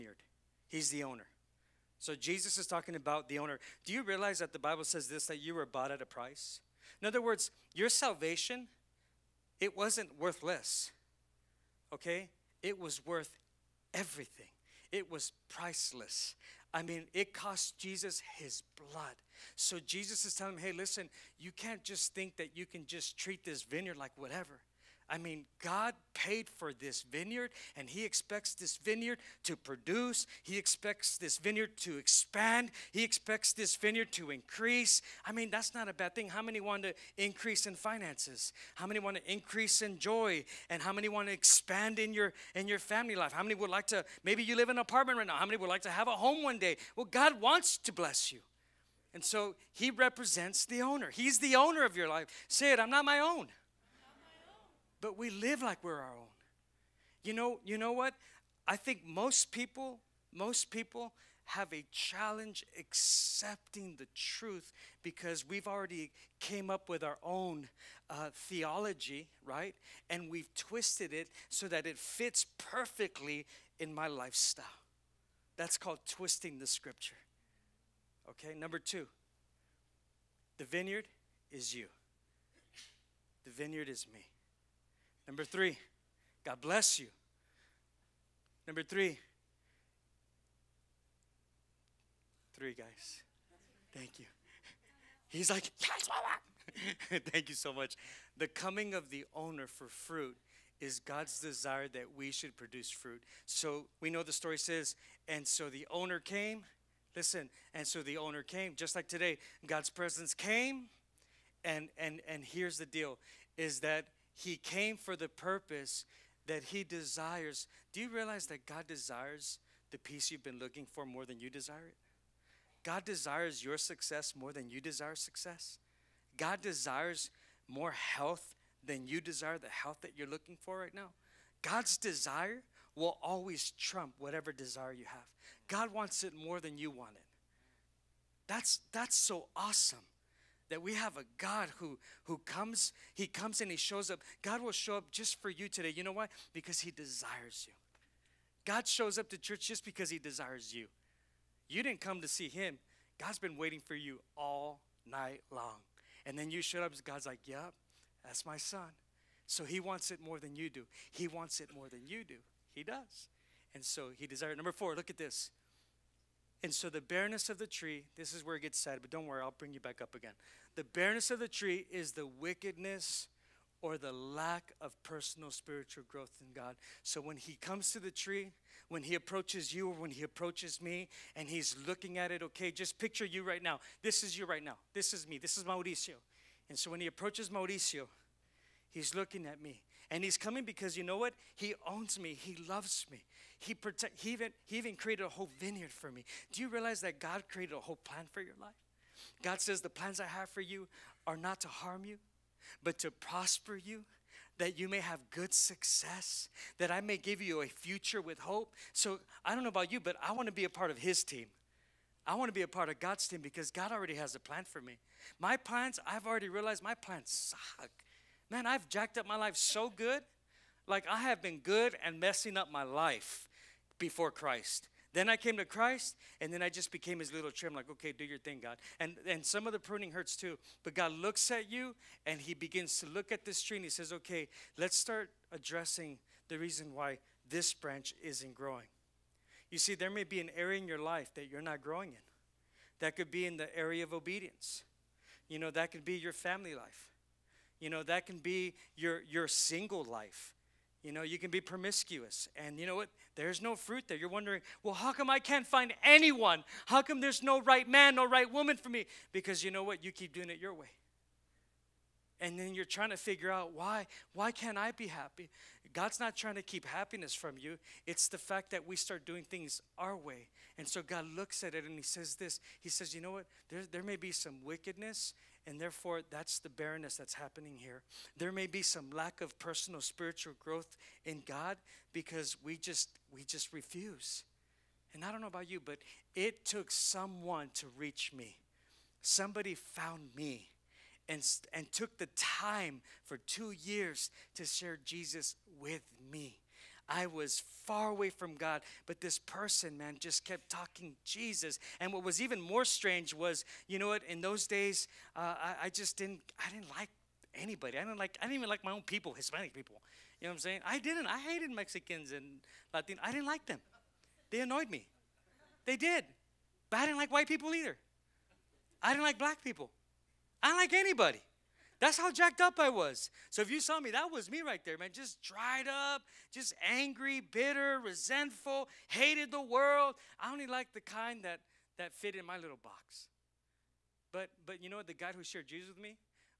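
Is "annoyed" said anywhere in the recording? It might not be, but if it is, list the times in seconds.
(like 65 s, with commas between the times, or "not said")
314 s.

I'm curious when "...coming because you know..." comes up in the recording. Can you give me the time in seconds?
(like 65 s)
190 s.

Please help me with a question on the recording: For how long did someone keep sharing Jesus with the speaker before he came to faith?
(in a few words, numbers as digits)
2 years.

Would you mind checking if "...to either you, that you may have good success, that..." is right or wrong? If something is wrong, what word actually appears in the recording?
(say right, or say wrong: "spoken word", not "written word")
wrong: "prosper", not "either".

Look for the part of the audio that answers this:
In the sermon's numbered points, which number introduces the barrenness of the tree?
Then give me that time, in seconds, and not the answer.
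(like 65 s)
164 s.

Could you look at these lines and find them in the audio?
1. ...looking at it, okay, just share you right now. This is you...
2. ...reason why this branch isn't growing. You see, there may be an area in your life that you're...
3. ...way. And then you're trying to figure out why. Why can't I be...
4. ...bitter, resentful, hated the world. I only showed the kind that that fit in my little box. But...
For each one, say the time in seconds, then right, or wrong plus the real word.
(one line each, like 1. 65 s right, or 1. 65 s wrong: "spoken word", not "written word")
1. 181 s wrong: "picture", not "share"
2. 236 s right
3. 260 s right
4. 327 s wrong: "liked", not "showed".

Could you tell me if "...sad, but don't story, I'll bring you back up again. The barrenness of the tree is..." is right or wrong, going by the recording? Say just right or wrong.
wrong.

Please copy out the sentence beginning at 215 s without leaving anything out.
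My plans, I've already realized my plans suck.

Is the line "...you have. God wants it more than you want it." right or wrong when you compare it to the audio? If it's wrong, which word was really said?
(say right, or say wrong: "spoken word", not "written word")
right.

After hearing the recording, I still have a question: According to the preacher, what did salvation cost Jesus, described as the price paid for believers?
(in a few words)
His blood.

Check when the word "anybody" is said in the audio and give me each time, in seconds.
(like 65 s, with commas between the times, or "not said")
307 s, 320 s.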